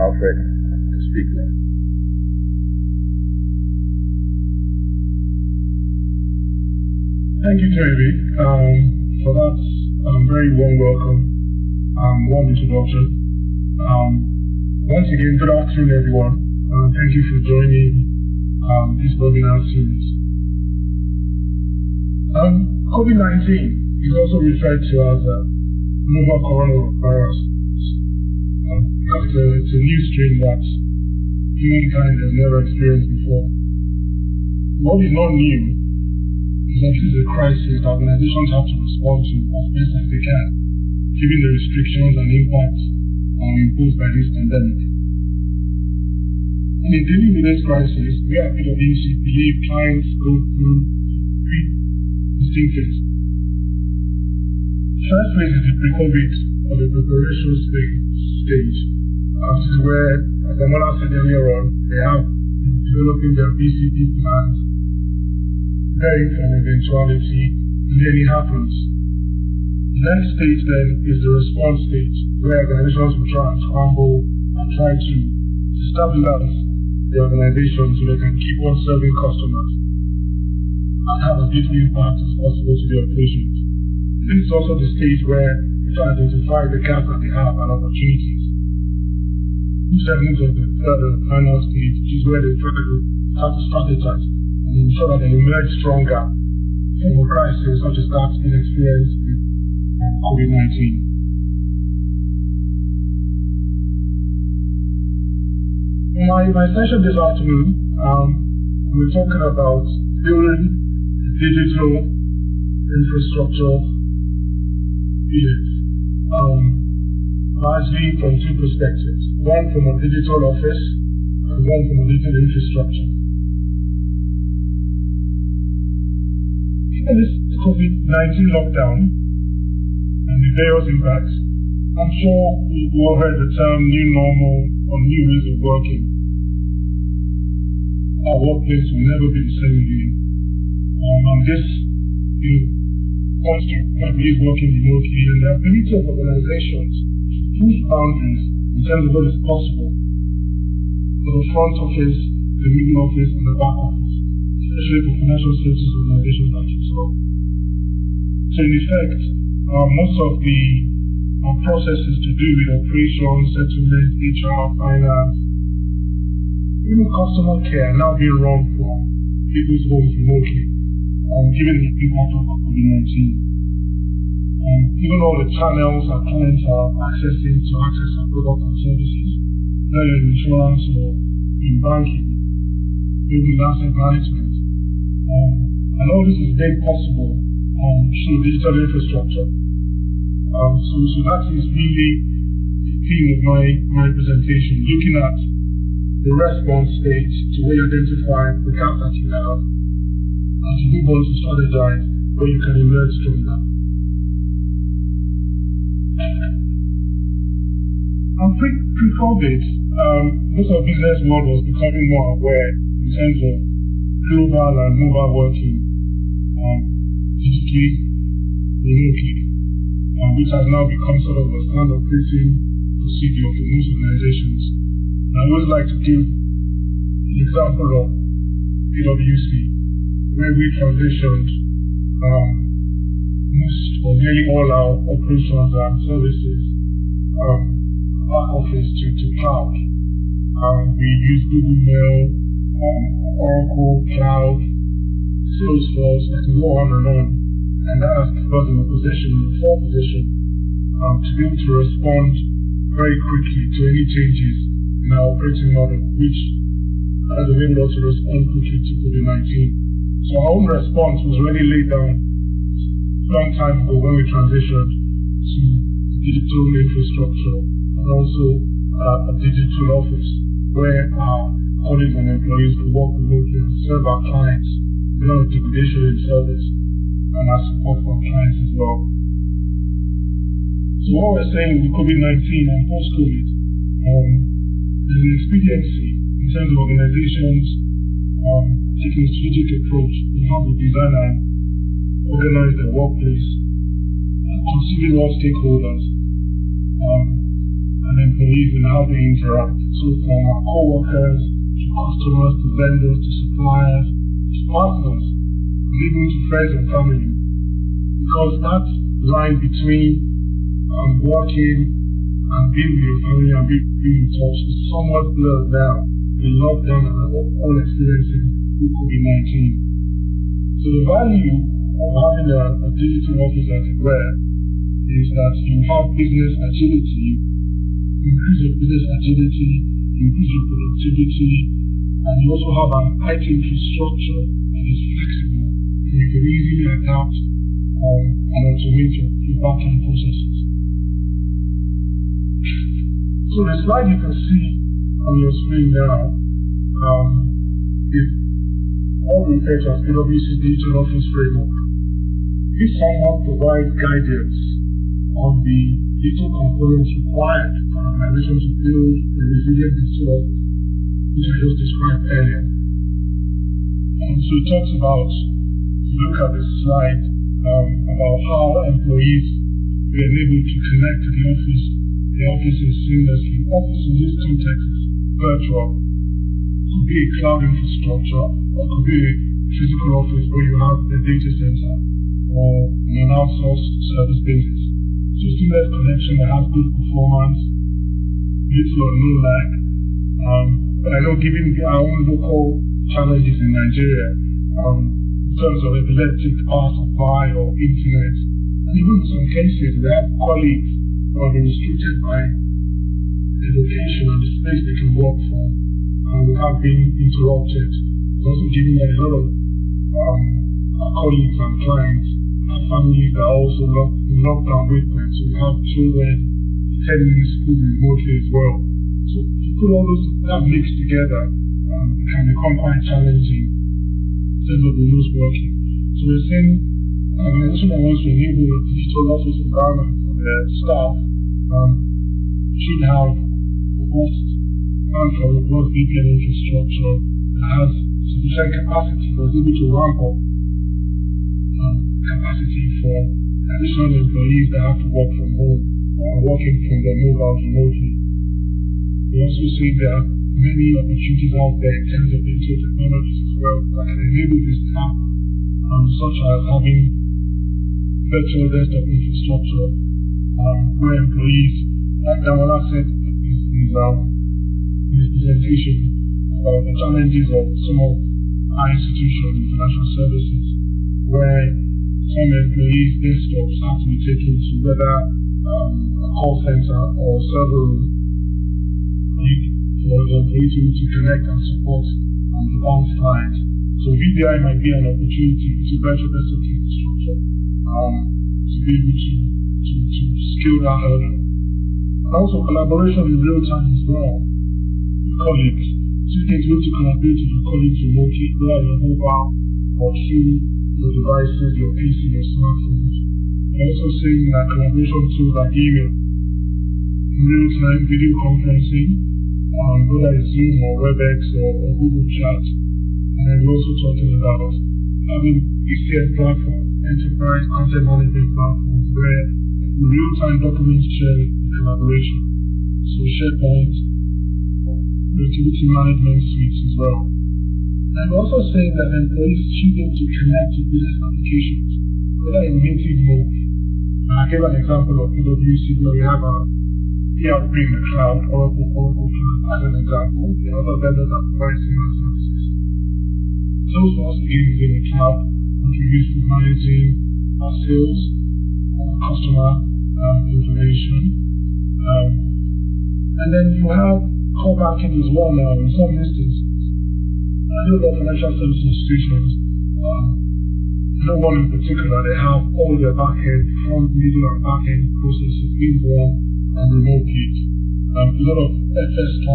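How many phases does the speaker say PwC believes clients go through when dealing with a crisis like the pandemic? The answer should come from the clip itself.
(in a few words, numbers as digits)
3.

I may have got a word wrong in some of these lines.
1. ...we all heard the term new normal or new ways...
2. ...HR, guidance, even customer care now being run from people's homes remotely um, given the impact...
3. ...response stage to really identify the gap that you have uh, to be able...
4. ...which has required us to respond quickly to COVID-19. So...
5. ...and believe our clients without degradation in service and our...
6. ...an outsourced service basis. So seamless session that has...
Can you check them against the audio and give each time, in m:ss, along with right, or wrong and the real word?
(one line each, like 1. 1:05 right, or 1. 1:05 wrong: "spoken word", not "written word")
1. 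2:12 right
2. 2:44 wrong: "finance", not "guidance"
3. 3:16 right
4. 4:16 wrong: "enabled", not "required"
5. 4:33 wrong: "serve", not "believe"
6. 6:23 wrong: "connection", not "session".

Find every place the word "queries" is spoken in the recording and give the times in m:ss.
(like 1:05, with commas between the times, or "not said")
not said.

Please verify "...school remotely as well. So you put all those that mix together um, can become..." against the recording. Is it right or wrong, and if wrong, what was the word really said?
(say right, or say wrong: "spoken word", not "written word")
right.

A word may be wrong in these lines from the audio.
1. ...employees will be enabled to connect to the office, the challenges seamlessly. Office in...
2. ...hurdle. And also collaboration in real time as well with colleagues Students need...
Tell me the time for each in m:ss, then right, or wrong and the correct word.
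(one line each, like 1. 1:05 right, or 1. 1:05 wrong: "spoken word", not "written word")
1. 6:08 wrong: "offices", not "challenges"
2. 8:10 right.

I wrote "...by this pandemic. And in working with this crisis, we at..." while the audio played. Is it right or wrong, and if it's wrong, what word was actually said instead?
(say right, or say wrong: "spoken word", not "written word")
wrong: "dealing", not "working".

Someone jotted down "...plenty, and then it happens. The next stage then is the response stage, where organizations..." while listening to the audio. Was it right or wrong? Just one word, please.
wrong.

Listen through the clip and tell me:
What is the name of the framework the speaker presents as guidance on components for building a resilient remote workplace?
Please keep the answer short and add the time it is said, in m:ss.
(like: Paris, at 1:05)
PwC Digital Office Framework, at 5:50.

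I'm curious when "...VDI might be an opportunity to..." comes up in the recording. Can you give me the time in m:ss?
8:04.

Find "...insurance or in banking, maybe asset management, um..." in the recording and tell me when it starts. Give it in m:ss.
3:00.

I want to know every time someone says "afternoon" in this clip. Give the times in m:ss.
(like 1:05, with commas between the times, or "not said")
0:15, 1:47.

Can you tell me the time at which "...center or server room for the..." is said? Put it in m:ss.
7:56.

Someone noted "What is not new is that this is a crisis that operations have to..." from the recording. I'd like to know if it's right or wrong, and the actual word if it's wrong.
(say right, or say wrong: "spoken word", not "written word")
wrong: "organizations", not "operations".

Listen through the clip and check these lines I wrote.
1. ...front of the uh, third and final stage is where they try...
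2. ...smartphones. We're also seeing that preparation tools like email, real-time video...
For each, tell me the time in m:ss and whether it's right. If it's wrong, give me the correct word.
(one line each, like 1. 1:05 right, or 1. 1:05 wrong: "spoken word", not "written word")
1. 1:30 wrong: "segment", not "front"
2. 8:22 wrong: "collaboration", not "preparation".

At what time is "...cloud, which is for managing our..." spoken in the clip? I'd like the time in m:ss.
9:05.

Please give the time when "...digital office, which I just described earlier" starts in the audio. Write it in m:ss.
6:00.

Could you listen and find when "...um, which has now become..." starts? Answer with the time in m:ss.
3:40.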